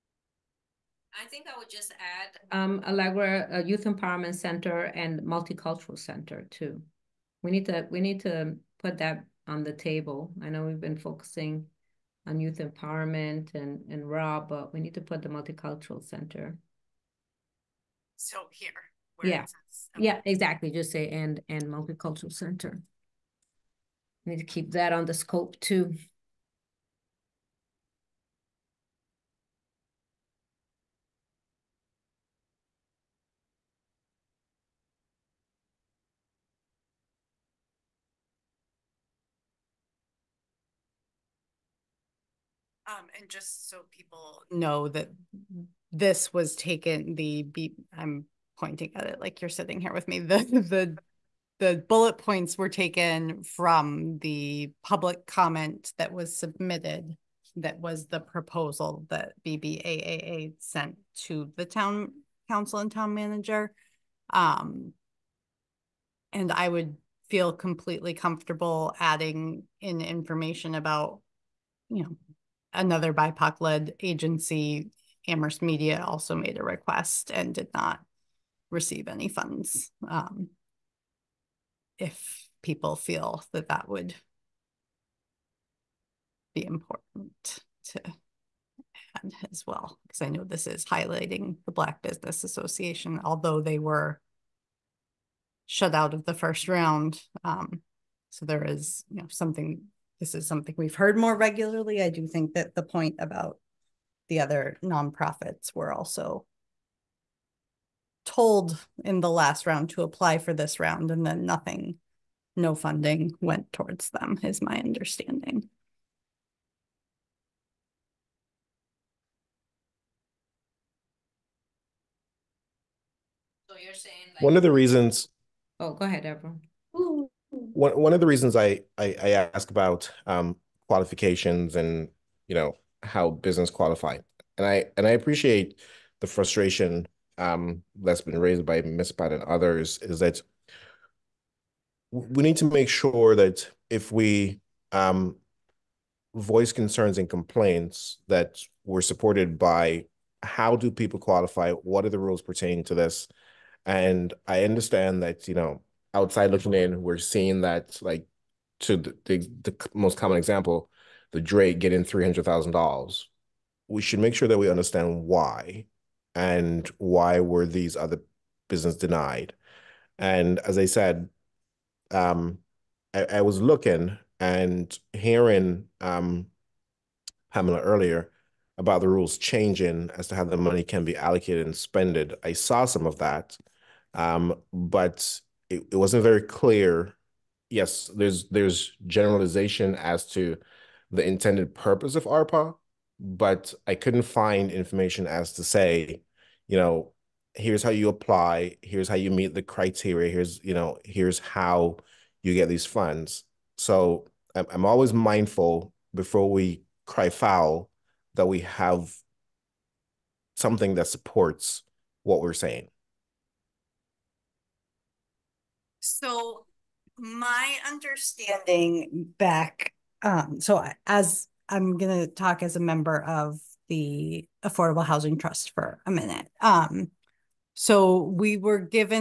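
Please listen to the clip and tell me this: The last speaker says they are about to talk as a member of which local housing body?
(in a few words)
Affordable Housing Trust.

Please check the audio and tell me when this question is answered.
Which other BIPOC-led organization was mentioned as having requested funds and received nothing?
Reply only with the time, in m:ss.
1:15.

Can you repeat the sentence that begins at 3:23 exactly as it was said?
So I'm, I'm always mindful before we cry foul that we have something that supports what we're saying.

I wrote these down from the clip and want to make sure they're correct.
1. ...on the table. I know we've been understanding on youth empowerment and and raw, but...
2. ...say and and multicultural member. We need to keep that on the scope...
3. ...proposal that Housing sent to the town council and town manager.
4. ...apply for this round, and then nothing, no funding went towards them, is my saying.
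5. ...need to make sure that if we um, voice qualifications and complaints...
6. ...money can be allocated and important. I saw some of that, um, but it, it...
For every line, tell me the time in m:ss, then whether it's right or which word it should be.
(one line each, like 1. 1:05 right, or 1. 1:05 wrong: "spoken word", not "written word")
1. 0:09 wrong: "focusing", not "understanding"
2. 0:20 wrong: "center", not "member"
3. 0:58 wrong: "BBAA", not "Housing"
4. 1:50 wrong: "understanding", not "saying"
5. 2:22 wrong: "concerns", not "qualifications"
6. 3:00 wrong: "spent", not "important".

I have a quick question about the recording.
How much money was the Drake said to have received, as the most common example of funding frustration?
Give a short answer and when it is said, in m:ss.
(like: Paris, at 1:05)
$300,000, at 2:42.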